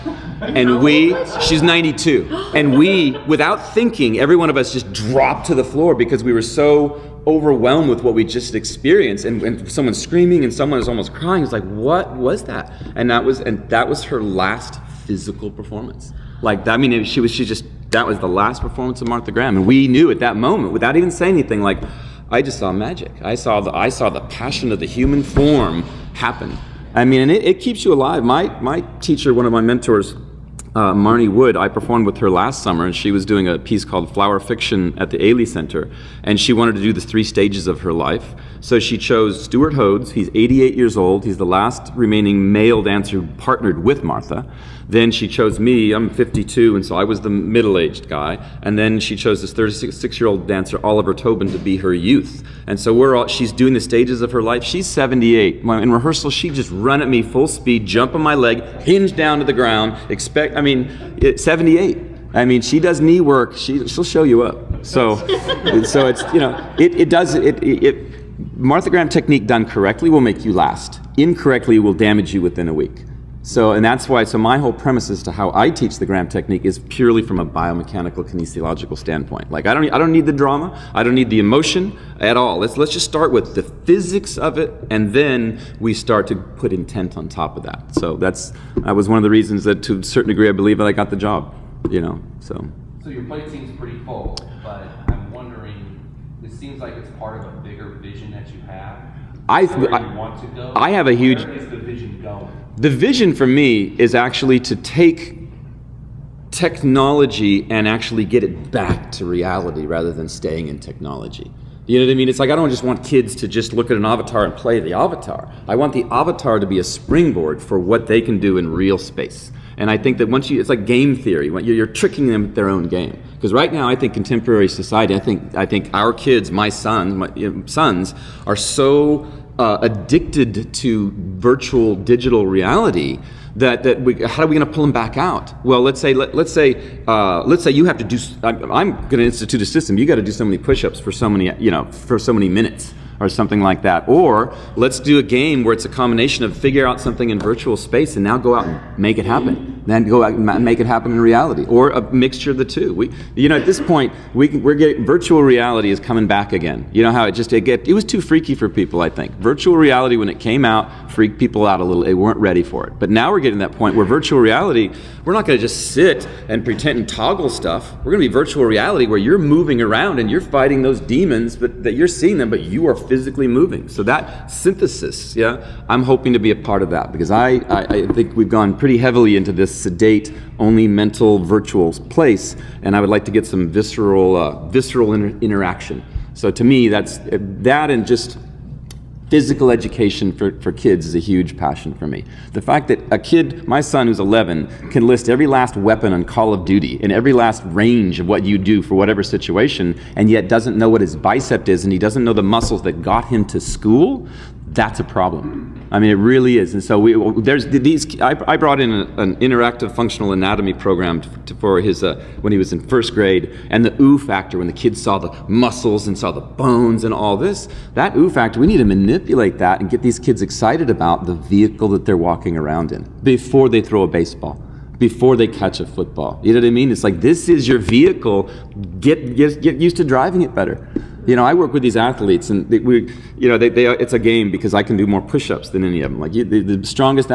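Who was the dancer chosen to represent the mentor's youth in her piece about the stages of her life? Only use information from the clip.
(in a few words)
Oliver Tobin.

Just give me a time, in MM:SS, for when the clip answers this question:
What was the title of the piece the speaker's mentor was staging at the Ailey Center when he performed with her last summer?
00:34.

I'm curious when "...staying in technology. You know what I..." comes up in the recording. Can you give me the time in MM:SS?
01:50.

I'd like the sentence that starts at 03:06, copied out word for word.
So to me, that's that and just physical education for, for kids is a huge passion for me.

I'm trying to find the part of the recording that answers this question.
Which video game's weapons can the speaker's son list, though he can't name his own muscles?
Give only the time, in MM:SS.
03:16.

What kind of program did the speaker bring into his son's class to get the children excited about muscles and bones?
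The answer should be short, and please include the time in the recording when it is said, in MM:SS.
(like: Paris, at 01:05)
interactive functional anatomy, at 03:29.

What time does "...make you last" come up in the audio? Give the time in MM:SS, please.
01:10.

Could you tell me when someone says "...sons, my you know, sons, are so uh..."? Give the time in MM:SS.
02:06.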